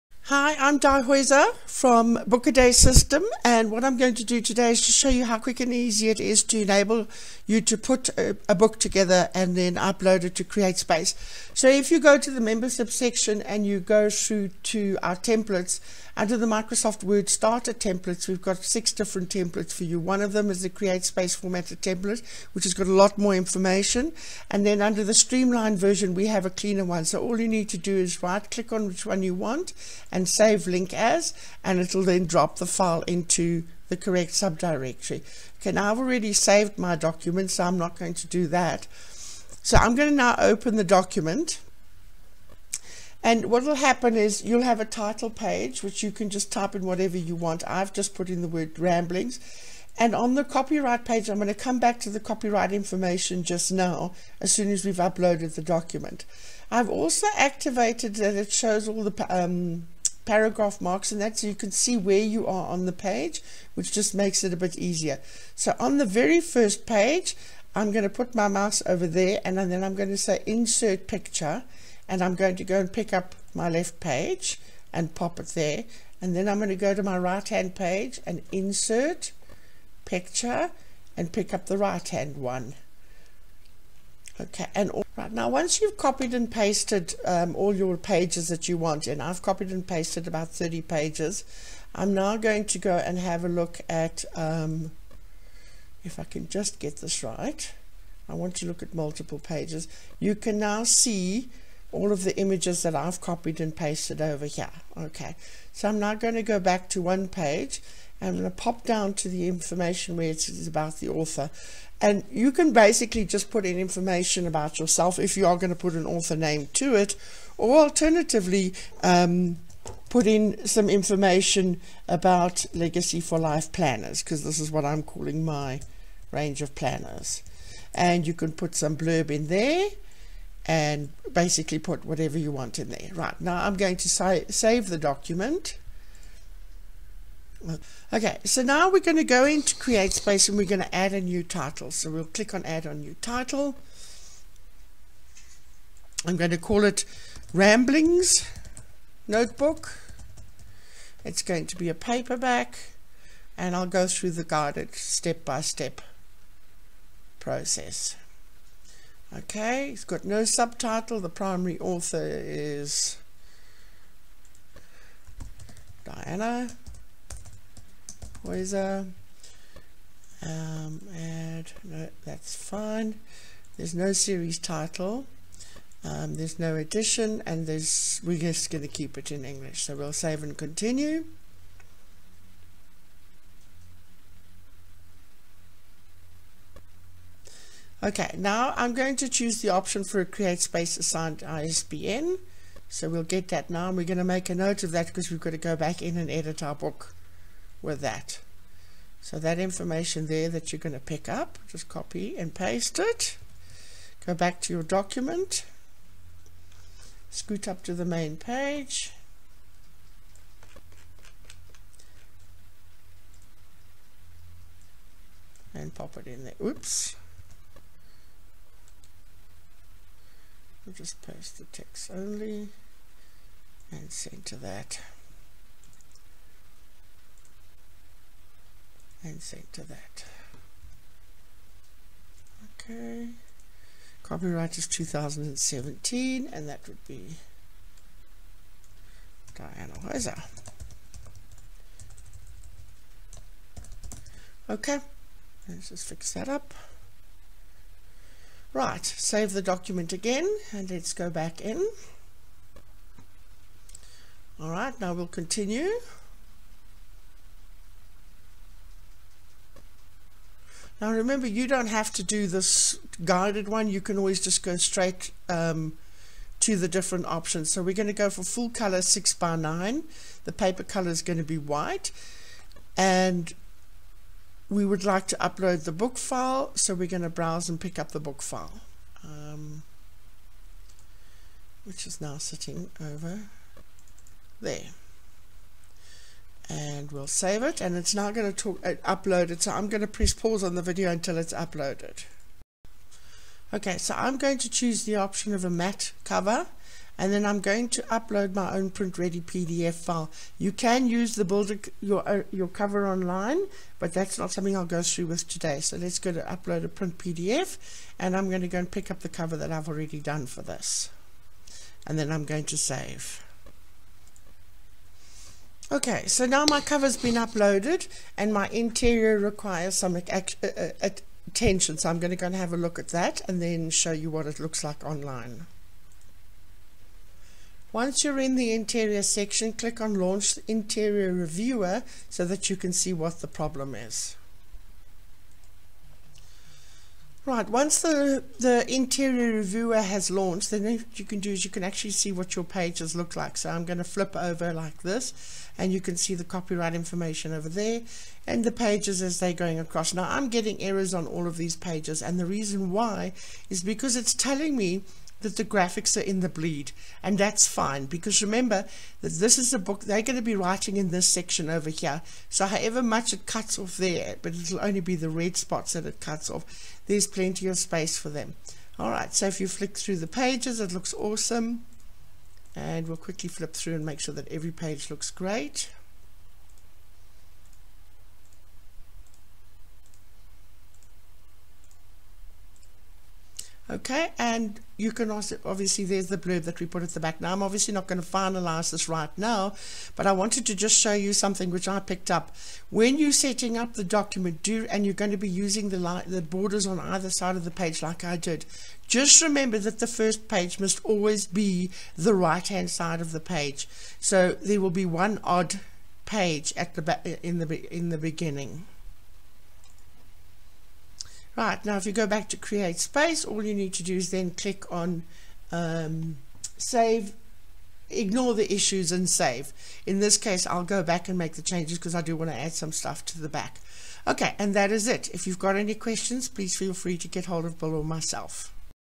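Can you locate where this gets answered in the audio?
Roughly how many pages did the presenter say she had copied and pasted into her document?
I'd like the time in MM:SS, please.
01:30.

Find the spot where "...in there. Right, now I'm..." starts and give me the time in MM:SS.
02:12.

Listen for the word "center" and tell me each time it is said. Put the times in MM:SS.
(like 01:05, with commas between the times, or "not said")
03:44, 03:49.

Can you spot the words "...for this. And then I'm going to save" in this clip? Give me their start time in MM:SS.
05:10.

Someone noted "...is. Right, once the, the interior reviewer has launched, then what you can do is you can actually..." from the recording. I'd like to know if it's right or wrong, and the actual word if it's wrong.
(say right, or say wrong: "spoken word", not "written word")
right.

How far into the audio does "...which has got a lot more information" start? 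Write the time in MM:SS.
00:22.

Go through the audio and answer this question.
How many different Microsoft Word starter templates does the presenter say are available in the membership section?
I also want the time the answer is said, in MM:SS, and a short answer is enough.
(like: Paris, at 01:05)
6, at 00:18.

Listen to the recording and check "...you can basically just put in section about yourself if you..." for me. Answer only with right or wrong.
wrong.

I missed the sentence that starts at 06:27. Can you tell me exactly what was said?
Now I'm obviously not going to finalize this right now, but I wanted to just show you something which I picked up.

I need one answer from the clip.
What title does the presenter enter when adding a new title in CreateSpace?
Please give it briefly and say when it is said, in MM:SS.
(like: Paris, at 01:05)
Ramblings Notebook, at 02:27.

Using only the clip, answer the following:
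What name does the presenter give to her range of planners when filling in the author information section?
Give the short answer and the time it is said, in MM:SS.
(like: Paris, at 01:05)
Legacy for Life planners, at 02:02.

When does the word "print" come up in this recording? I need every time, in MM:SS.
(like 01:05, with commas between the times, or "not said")
04:58, 05:06.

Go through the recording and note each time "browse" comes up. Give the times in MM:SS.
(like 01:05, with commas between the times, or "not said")
04:37.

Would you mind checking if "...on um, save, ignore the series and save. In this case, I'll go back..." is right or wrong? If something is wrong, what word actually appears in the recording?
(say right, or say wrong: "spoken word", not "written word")
wrong: "issues", not "series".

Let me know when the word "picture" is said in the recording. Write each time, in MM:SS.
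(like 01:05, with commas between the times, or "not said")
01:11, 01:20.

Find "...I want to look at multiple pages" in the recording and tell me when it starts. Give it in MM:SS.
01:38.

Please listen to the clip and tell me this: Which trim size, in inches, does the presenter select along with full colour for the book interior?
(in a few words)
6 by 9.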